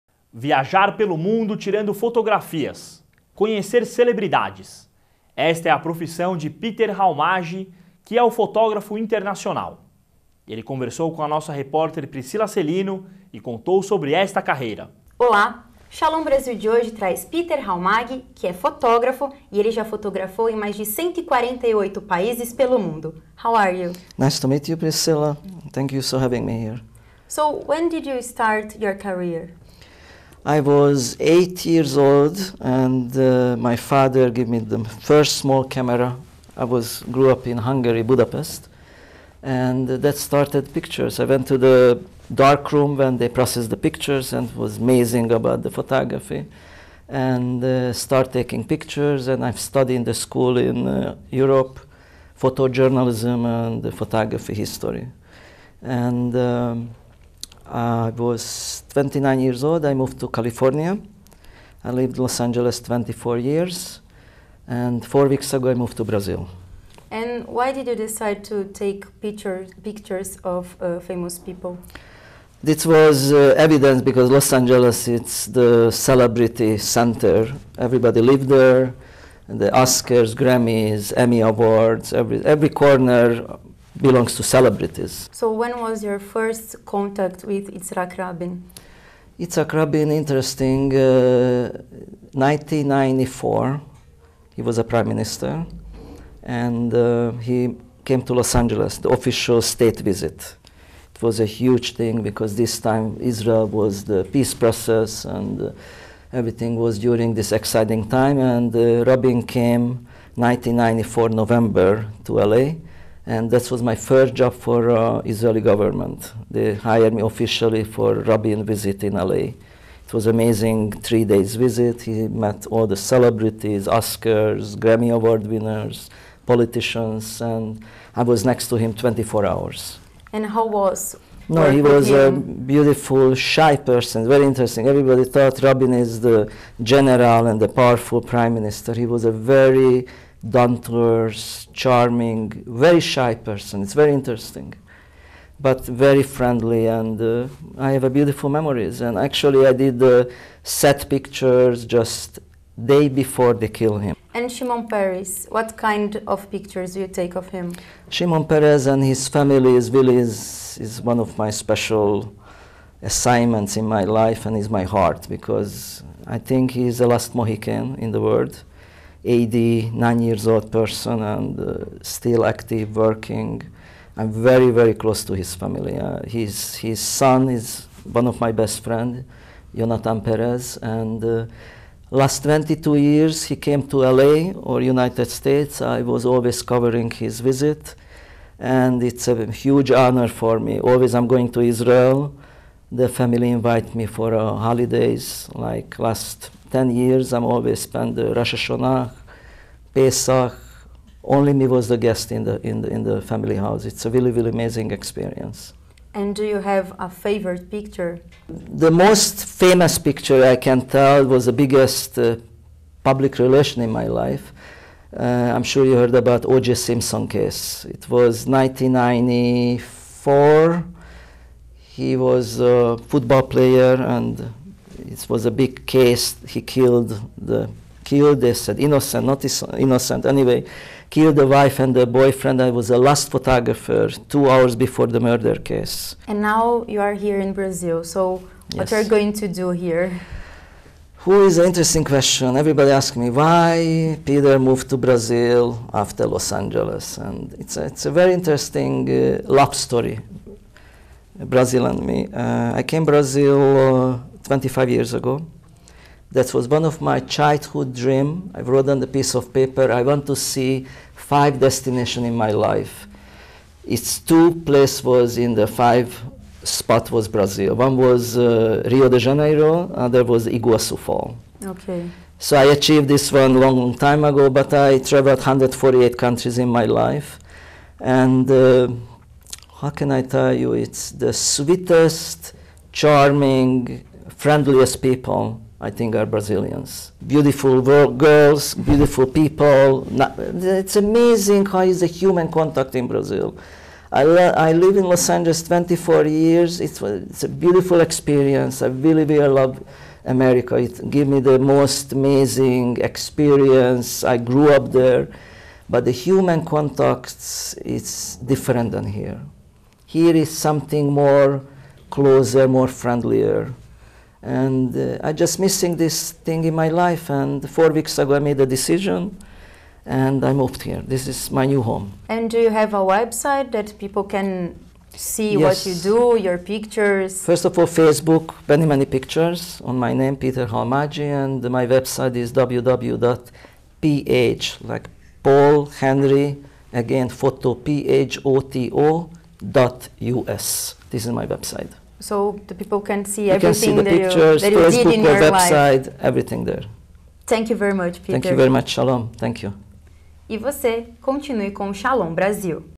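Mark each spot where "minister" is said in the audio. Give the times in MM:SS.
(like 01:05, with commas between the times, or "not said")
01:35, 02:18.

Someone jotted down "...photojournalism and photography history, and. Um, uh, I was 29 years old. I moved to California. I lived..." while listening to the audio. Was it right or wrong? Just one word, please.
right.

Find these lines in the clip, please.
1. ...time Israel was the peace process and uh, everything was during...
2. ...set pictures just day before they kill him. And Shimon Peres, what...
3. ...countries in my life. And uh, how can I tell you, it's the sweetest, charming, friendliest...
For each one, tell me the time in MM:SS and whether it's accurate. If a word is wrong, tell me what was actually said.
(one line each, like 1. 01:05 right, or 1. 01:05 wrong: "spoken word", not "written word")
1. 01:42 right
2. 02:30 right
3. 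04:36 right.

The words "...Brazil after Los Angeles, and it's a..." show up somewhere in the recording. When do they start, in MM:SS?
04:04.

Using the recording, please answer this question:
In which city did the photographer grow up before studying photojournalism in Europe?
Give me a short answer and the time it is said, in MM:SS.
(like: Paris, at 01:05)
Budapest, at 00:38.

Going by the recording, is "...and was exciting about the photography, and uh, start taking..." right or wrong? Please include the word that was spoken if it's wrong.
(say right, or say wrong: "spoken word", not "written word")
wrong: "amazing", not "exciting".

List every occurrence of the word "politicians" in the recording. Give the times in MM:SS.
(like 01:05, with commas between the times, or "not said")
02:06.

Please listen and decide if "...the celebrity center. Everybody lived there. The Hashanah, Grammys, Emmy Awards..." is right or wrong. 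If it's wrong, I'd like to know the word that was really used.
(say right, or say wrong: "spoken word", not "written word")
wrong: "Oscars", not "Hashanah".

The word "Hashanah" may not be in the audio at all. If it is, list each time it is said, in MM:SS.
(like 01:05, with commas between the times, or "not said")
03:18.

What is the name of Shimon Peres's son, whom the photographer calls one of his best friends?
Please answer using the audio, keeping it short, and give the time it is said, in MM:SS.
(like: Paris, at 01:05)
Jonathan Peres, at 02:59.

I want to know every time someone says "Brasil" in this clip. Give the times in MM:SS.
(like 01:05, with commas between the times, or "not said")
00:16, 05:52.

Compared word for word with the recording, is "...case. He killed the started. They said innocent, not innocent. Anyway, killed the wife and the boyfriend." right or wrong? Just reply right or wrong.
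wrong.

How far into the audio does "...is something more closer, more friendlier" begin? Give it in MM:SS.
05:10.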